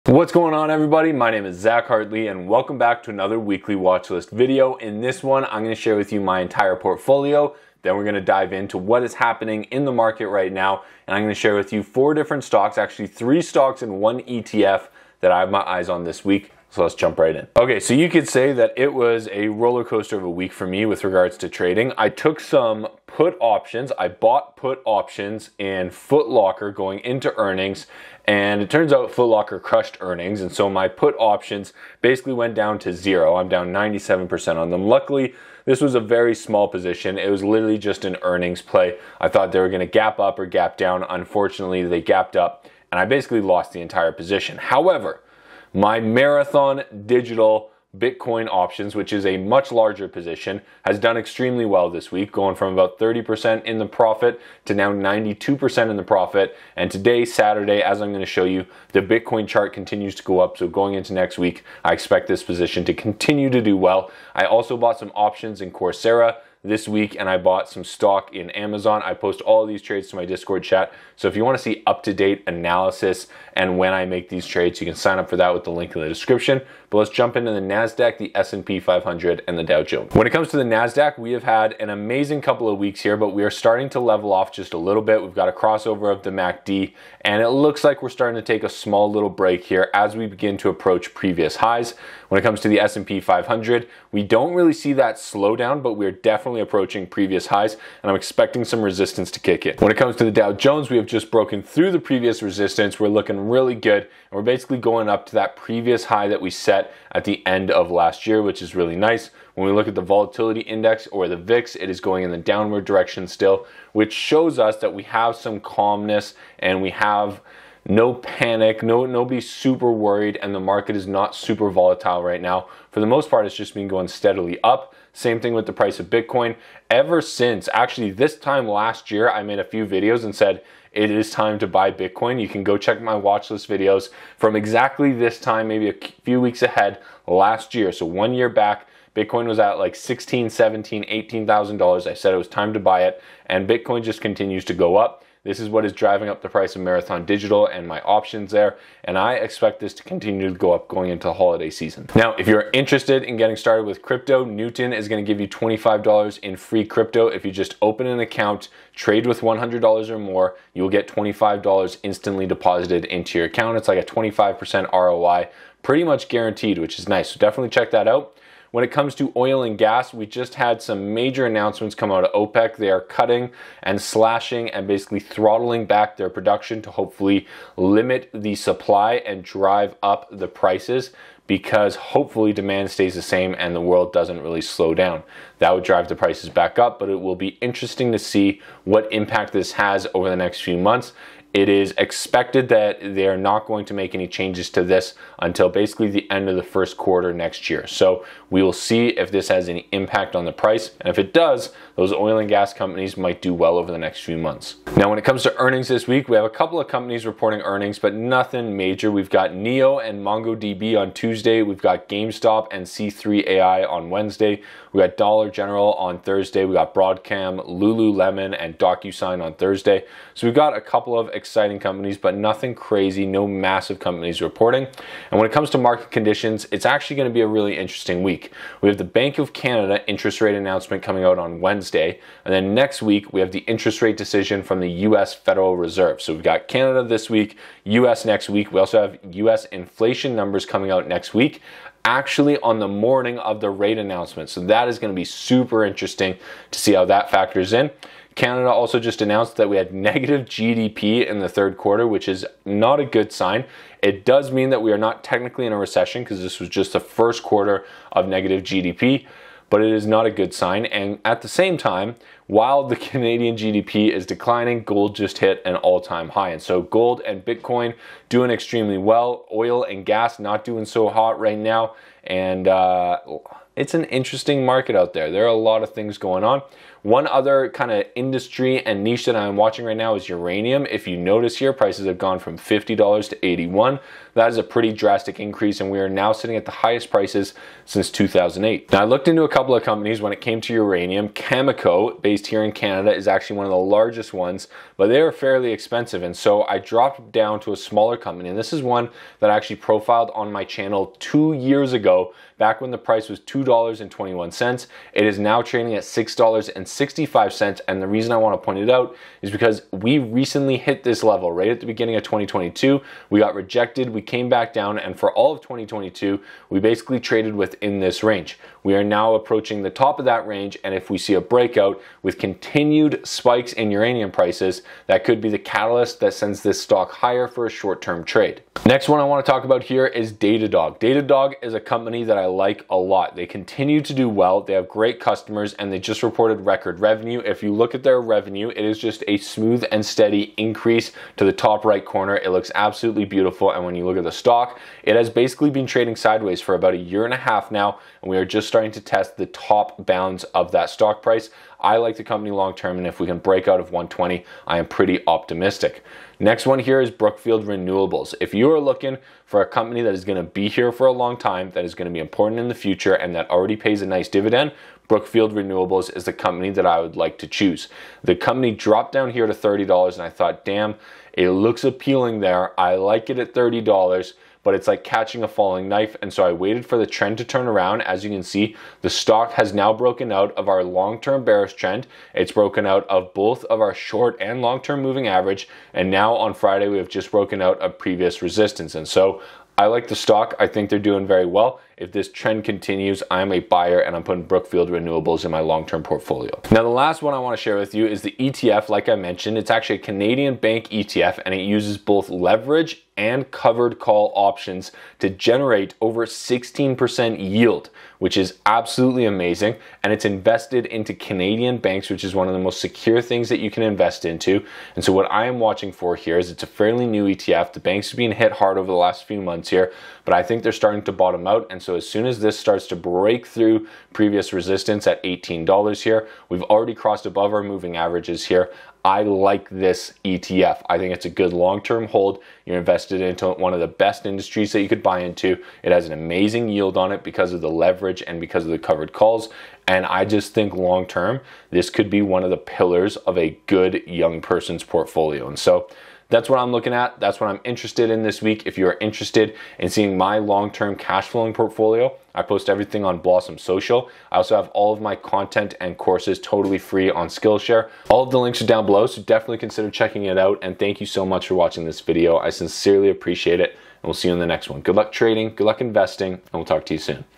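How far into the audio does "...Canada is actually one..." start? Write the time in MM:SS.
04:52.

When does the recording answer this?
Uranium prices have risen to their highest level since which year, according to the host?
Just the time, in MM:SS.
04:48.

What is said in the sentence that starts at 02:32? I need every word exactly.
Now, if you're interested in getting started with crypto, Newton is gonna give you $25 in free crypto.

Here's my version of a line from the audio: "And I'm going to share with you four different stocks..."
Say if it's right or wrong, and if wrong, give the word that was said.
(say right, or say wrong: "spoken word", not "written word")
right.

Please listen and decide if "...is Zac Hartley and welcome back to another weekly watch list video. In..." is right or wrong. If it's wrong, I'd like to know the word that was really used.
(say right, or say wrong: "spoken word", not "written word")
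right.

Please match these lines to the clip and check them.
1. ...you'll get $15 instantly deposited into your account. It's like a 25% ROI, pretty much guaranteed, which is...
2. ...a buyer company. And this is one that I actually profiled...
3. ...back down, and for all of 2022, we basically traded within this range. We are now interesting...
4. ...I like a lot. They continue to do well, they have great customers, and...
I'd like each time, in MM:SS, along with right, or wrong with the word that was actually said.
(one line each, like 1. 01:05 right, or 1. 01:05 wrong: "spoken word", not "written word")
1. 02:40 wrong: "25", not "15"
2. 04:57 wrong: "smaller", not "buyer"
3. 05:14 wrong: "approaching", not "interesting"
4. 05:32 right.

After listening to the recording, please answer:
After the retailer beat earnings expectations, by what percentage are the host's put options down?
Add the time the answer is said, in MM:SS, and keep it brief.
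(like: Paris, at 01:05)
97%, at 00:33.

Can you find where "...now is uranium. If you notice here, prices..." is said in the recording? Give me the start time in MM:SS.
04:39.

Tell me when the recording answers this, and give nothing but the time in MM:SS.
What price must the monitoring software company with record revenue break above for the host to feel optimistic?
05:53.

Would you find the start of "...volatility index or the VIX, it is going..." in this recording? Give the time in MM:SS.
01:50.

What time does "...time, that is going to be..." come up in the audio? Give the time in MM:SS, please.
06:01.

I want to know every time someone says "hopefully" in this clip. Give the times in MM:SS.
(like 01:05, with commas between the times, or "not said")
02:56, 03:01.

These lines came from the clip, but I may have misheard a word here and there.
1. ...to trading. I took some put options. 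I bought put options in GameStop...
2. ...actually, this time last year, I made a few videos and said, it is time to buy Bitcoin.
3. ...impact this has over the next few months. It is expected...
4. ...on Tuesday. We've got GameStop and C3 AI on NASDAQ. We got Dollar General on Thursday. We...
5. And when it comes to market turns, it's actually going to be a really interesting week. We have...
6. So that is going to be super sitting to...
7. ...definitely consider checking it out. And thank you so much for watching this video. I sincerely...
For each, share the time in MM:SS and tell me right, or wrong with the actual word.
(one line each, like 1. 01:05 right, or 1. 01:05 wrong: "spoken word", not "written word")
1. 00:21 wrong: "Footlocker", not "GameStop"
2. 02:07 right
3. 03:09 right
4. 03:30 wrong: "Wednesday", not "NASDAQ"
5. 03:45 wrong: "conditions", not "turns"
6. 04:04 wrong: "interesting", not "sitting"
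7. 07:39 right.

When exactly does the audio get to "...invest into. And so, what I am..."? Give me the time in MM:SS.
06:53.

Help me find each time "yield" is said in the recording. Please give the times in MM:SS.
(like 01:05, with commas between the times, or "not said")
06:47, 07:16.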